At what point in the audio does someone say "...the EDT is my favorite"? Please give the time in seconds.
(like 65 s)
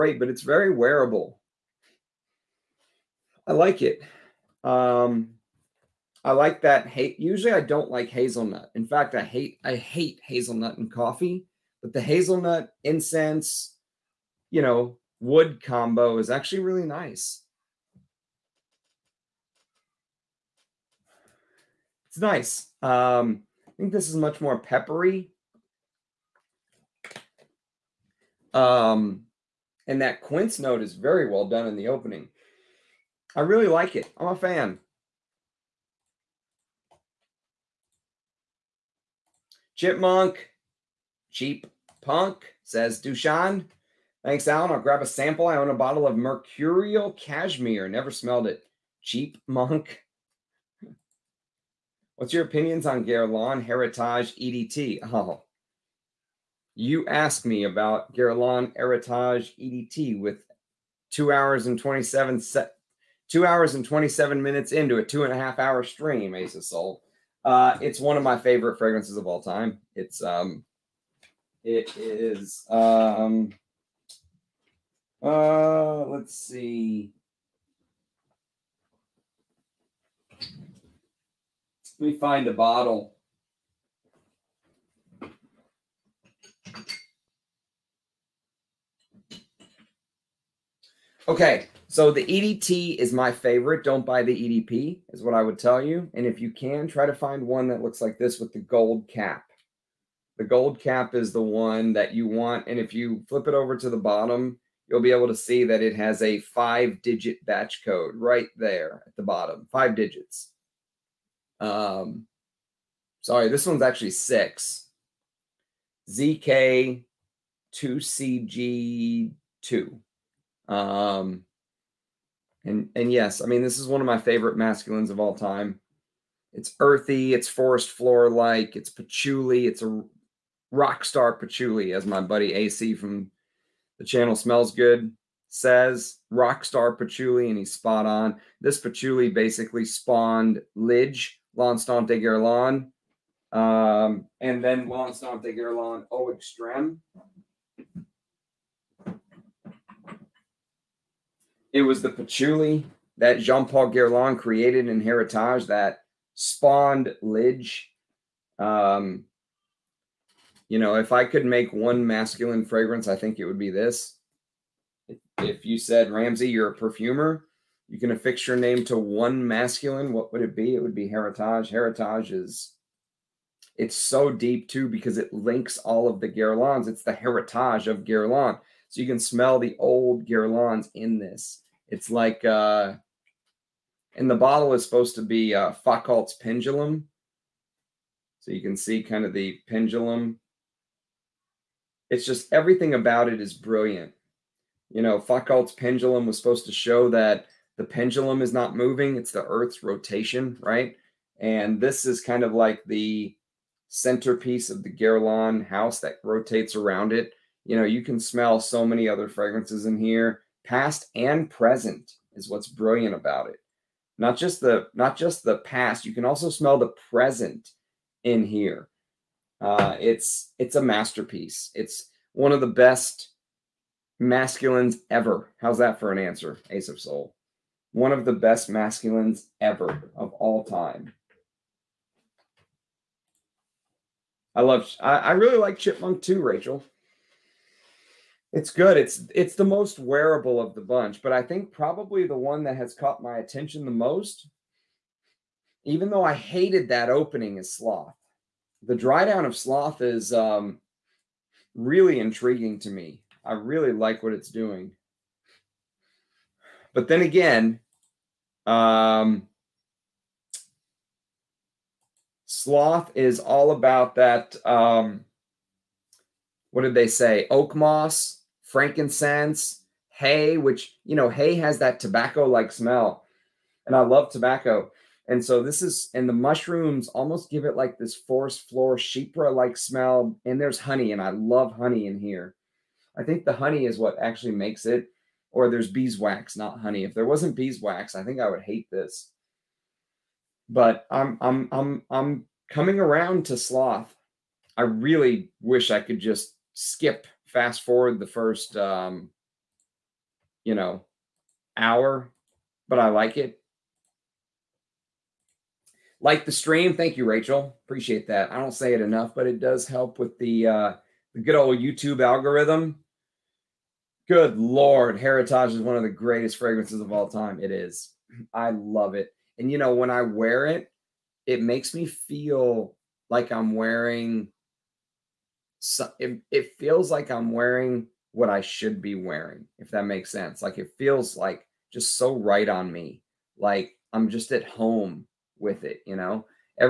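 92 s.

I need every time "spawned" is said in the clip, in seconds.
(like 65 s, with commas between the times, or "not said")
139 s, 156 s.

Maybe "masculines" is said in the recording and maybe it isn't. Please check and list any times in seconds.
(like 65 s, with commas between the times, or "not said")
124 s, 162 s, 169 s, 224 s, 228 s.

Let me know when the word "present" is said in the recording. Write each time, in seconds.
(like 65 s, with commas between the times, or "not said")
211 s, 217 s.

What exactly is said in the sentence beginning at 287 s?
If there wasn't beeswax, I think I would hate this.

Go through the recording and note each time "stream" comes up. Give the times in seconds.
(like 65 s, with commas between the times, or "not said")
65 s, 306 s.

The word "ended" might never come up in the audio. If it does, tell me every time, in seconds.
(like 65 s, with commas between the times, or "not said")
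not said.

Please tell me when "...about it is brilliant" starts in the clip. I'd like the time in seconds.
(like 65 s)
192 s.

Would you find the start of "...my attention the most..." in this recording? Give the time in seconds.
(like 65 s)
243 s.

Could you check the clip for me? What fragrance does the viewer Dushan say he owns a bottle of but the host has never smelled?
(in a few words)
Mercurial Cashmere.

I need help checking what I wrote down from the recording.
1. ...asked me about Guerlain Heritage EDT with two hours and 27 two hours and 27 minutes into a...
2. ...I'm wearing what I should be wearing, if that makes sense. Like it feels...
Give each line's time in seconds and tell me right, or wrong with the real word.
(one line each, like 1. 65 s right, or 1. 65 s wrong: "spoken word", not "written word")
1. 57 s right
2. 327 s right.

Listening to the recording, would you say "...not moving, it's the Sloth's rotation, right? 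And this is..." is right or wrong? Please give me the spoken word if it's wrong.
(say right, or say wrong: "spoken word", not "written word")
wrong: "Earth", not "Sloth".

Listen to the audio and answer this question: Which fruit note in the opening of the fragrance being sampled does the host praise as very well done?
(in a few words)
quince.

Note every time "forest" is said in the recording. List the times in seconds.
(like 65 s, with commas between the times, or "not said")
127 s, 278 s.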